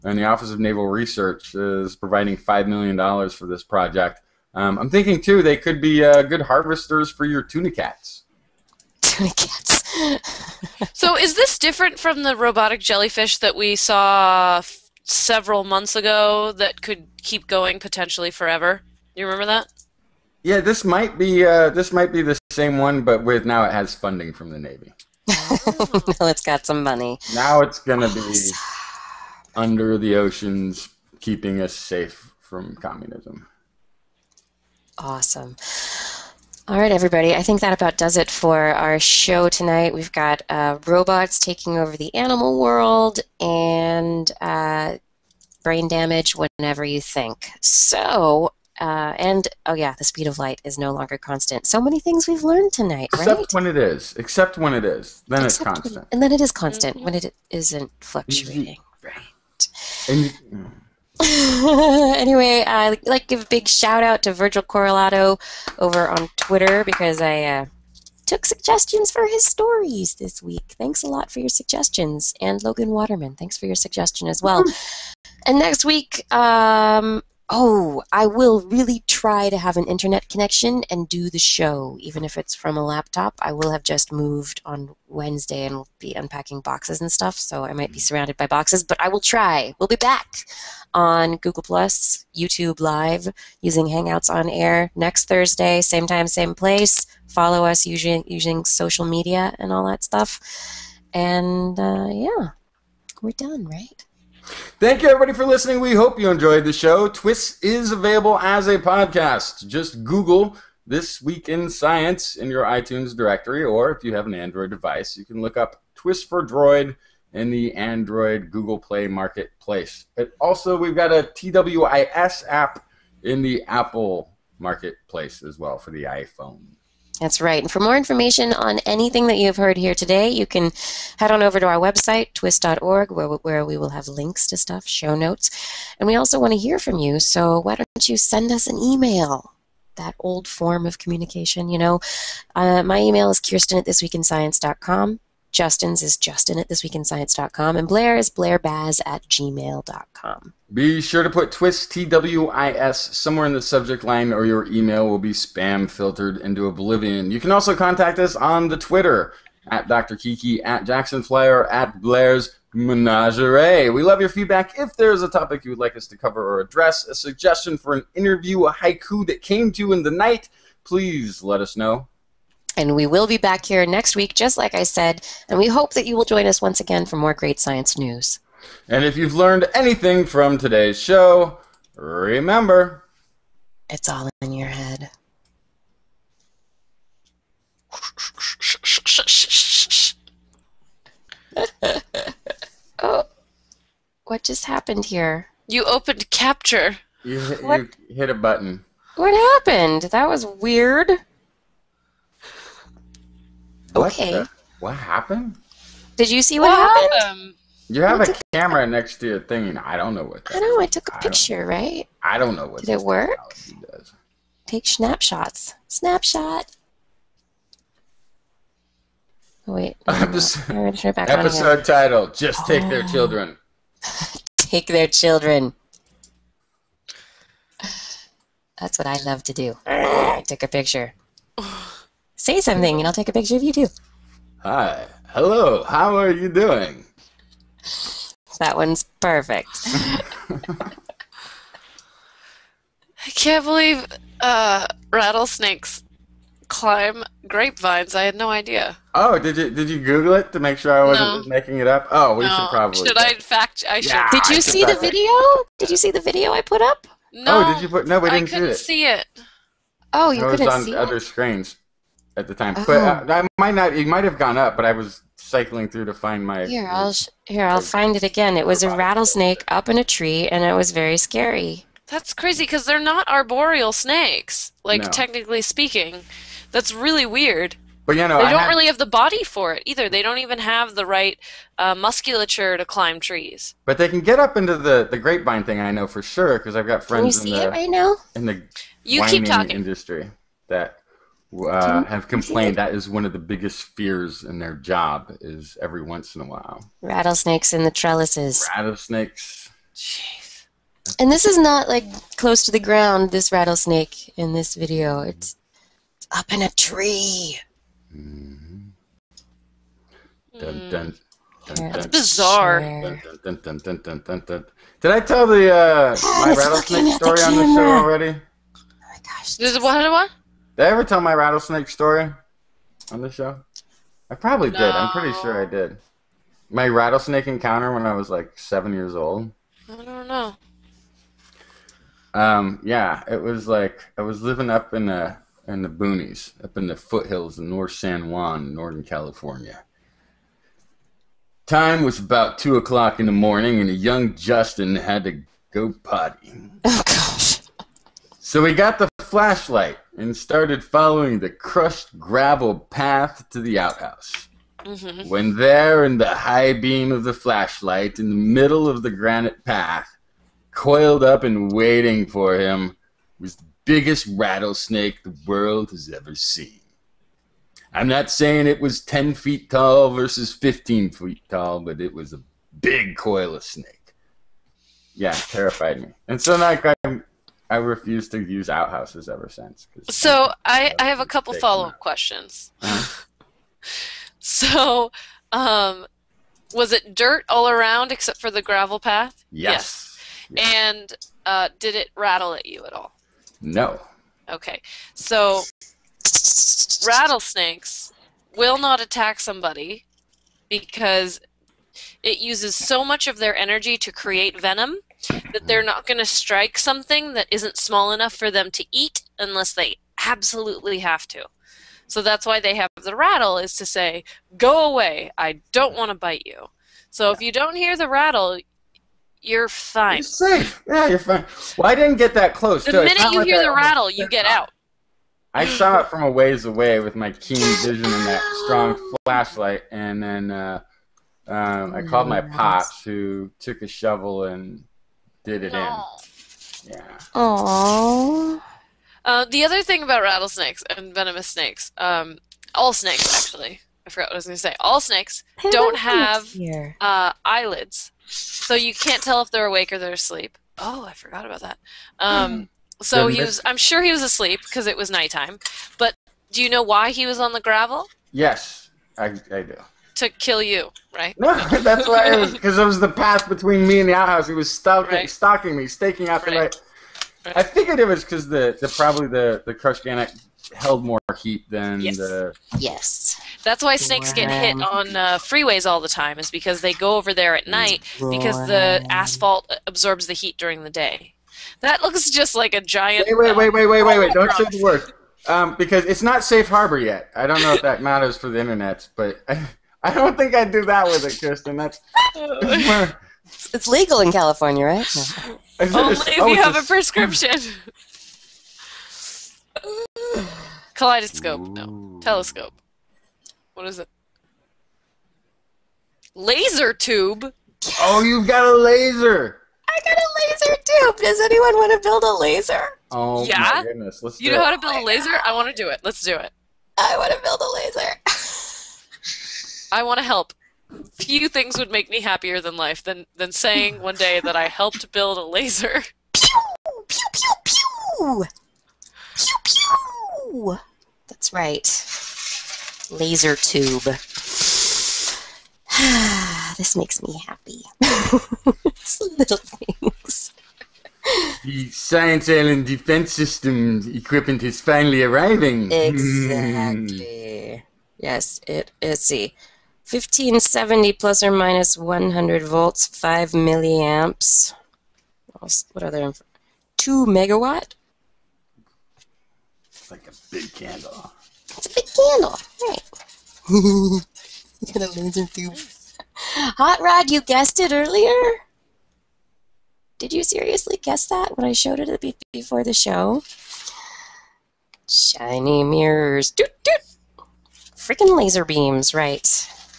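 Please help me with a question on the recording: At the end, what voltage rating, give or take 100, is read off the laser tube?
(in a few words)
1570 volts.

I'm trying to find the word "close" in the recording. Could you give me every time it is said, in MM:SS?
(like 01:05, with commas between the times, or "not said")
05:02, 07:02.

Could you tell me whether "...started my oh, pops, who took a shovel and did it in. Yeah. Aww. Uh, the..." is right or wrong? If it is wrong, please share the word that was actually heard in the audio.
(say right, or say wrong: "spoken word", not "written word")
wrong: "called", not "started".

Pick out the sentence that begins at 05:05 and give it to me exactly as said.
it's, up in a tree mm-hmm.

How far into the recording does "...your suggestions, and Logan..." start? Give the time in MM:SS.
01:11.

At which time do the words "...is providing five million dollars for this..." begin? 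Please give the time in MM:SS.
00:01.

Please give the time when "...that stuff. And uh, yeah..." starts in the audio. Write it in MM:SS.
01:39.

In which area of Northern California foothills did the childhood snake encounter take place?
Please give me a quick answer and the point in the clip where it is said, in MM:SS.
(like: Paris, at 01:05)
North San Juan, at 05:37.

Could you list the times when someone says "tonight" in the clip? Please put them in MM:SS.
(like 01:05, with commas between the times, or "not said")
00:39, 00:52.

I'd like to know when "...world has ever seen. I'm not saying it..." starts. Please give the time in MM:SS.
06:05.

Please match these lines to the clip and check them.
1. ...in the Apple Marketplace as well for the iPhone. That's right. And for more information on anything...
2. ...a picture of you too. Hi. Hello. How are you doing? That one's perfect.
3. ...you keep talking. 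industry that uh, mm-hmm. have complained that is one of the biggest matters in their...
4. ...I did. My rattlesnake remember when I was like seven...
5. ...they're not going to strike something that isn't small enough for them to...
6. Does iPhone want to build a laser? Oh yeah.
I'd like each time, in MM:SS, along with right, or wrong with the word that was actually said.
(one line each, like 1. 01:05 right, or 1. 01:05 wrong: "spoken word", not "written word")
1. 02:03 right
2. 03:53 right
3. 04:49 wrong: "fears", not "matters"
4. 05:25 wrong: "encounter", not "remember"
5. 06:45 right
6. 08:31 wrong: "anyone", not "iPhone".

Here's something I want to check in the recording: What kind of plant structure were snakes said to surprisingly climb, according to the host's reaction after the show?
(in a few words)
grapevines.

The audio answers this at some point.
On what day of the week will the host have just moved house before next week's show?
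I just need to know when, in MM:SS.
01:25.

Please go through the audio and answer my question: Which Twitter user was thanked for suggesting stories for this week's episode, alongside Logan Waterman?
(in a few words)
Virgil Corralado.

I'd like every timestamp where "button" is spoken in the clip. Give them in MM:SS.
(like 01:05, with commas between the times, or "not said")
03:18.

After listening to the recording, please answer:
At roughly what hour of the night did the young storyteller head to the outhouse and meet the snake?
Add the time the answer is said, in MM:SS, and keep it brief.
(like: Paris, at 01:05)
2 o'clock, at 05:42.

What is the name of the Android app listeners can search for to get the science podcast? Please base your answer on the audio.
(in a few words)
TWIS for Droid.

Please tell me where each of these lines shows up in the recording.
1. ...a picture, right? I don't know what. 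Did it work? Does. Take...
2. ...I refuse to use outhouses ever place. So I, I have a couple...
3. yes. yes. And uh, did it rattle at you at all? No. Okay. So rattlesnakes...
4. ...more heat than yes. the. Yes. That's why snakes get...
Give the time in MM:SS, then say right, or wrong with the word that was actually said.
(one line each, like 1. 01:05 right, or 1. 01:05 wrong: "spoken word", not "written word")
1. 03:31 right
2. 06:17 wrong: "since", not "place"
3. 06:30 right
4. 07:51 right.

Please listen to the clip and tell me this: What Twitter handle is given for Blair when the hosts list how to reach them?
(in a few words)
Blair's Menagerie.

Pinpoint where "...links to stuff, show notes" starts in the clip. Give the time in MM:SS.
02:14.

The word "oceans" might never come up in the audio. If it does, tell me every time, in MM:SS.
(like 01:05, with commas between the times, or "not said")
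00:30.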